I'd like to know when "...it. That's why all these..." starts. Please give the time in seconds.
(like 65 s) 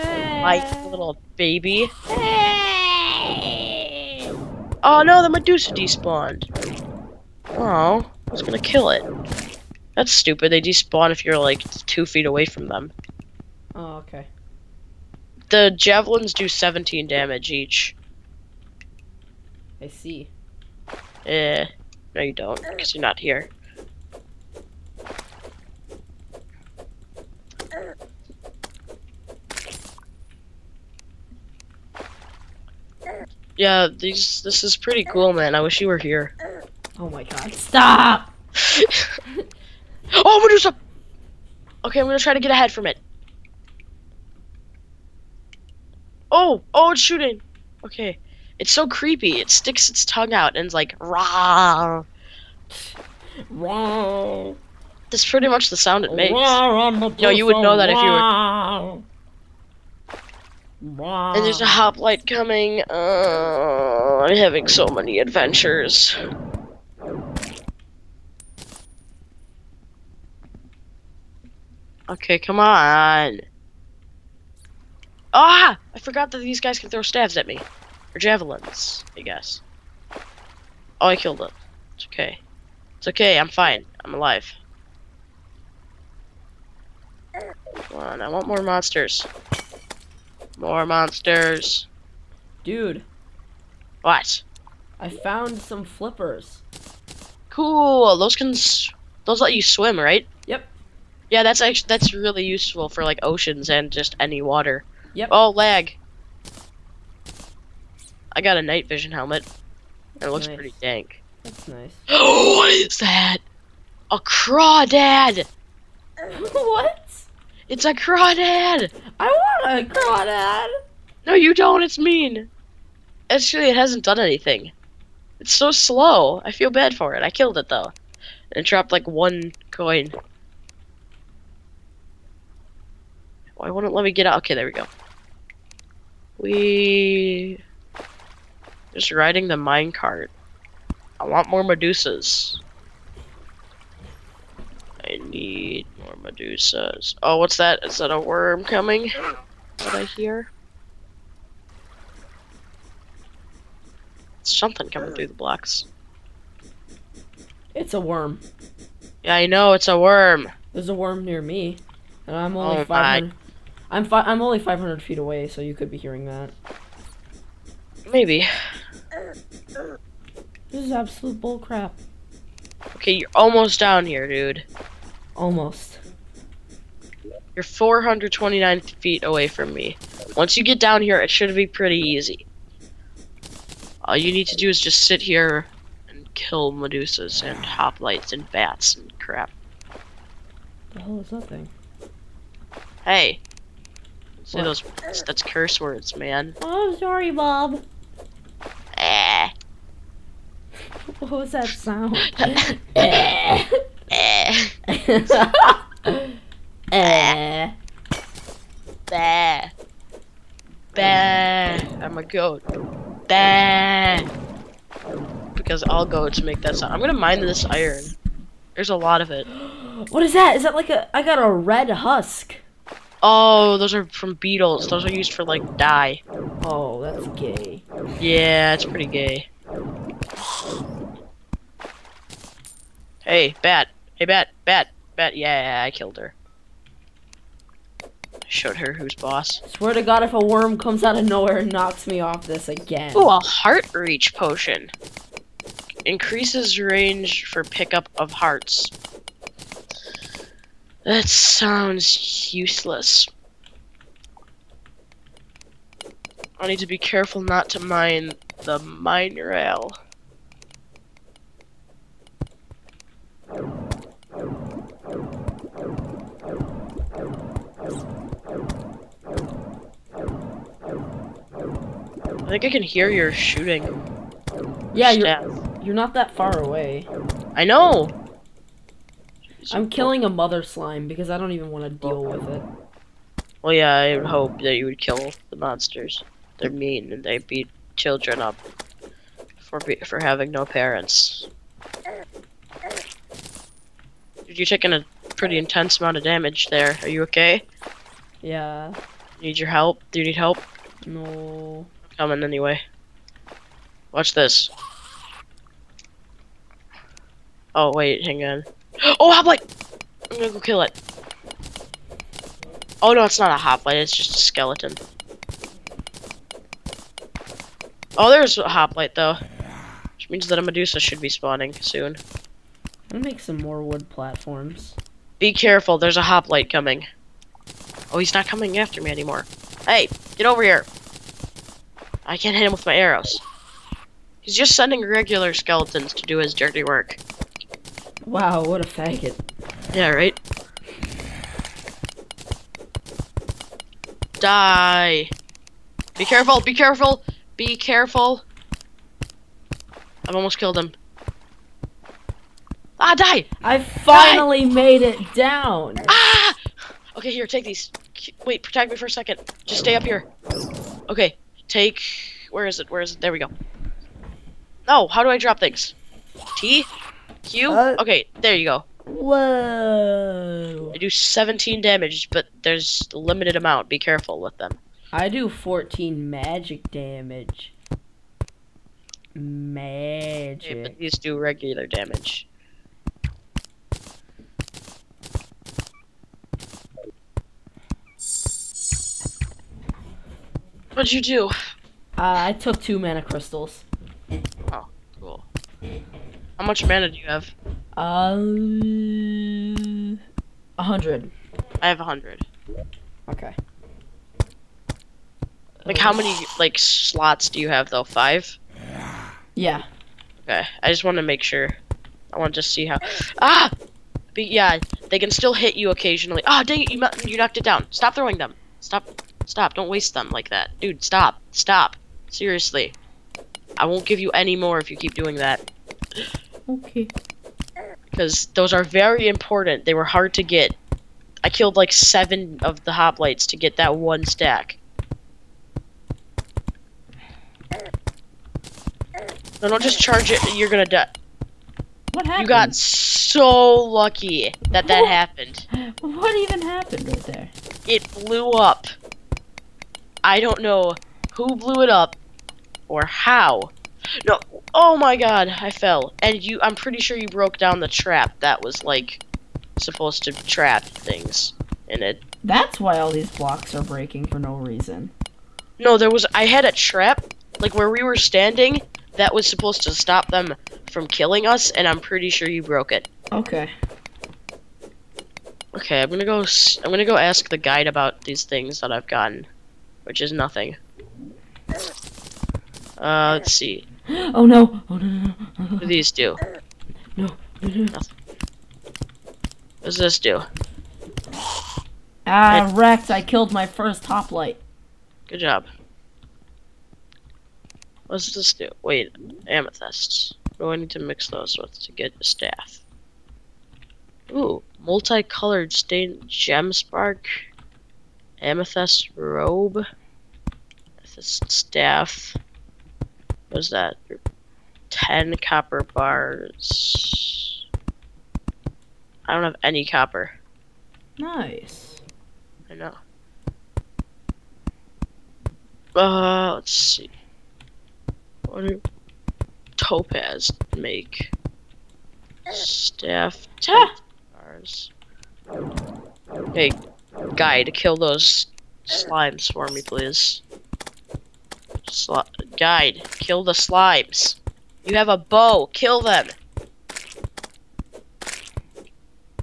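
462 s.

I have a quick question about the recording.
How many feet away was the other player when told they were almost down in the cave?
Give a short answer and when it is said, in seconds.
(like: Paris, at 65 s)
429, at 177 s.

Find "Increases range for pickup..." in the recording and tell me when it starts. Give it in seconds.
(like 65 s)
246 s.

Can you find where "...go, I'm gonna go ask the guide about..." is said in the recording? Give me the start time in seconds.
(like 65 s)
476 s.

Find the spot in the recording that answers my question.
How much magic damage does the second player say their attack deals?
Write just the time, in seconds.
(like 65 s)
375 s.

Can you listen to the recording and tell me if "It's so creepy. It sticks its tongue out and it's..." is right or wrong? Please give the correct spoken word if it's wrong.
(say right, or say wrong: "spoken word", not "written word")
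right.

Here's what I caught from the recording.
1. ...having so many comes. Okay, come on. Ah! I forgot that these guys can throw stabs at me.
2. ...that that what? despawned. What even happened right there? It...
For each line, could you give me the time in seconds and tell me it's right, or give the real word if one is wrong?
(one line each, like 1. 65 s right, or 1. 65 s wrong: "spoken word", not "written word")
1. 64 s wrong: "adventures", not "comes"
2. 444 s wrong: "happened", not "despawned".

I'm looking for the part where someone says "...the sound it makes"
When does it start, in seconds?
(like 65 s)
55 s.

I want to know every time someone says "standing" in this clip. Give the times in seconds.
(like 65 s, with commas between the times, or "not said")
468 s.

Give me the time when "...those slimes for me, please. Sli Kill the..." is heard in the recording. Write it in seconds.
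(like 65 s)
537 s.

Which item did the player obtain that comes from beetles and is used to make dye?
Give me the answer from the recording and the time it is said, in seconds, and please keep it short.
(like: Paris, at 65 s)
Red husk, at 221 s.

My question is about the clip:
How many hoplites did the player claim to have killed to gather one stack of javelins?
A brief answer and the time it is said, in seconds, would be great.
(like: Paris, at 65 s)
Seven, at 431 s.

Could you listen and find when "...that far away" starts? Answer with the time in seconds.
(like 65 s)
276 s.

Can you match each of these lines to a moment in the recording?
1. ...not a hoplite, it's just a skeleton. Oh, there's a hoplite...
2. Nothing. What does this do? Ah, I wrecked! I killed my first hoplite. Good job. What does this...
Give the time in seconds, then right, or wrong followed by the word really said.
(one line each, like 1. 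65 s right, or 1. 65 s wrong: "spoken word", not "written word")
1. 313 s right
2. 487 s right.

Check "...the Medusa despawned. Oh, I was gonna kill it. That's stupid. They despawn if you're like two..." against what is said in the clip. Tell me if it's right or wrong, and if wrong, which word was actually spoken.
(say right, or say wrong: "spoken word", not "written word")
right.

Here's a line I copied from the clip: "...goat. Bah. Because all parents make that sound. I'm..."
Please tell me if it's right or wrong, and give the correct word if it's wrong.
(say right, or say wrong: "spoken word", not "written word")
wrong: "goats", not "parents".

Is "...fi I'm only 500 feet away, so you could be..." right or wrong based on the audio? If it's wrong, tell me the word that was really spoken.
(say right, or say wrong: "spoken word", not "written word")
right.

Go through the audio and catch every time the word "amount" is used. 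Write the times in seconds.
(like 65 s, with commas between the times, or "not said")
295 s, 373 s.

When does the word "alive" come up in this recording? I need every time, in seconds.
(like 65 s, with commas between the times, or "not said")
84 s.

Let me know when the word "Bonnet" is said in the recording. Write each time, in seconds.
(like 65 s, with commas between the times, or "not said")
not said.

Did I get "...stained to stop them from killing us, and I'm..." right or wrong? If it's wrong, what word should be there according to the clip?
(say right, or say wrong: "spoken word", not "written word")
wrong: "supposed", not "stained".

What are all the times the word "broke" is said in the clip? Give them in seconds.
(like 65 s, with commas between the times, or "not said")
457 s, 472 s.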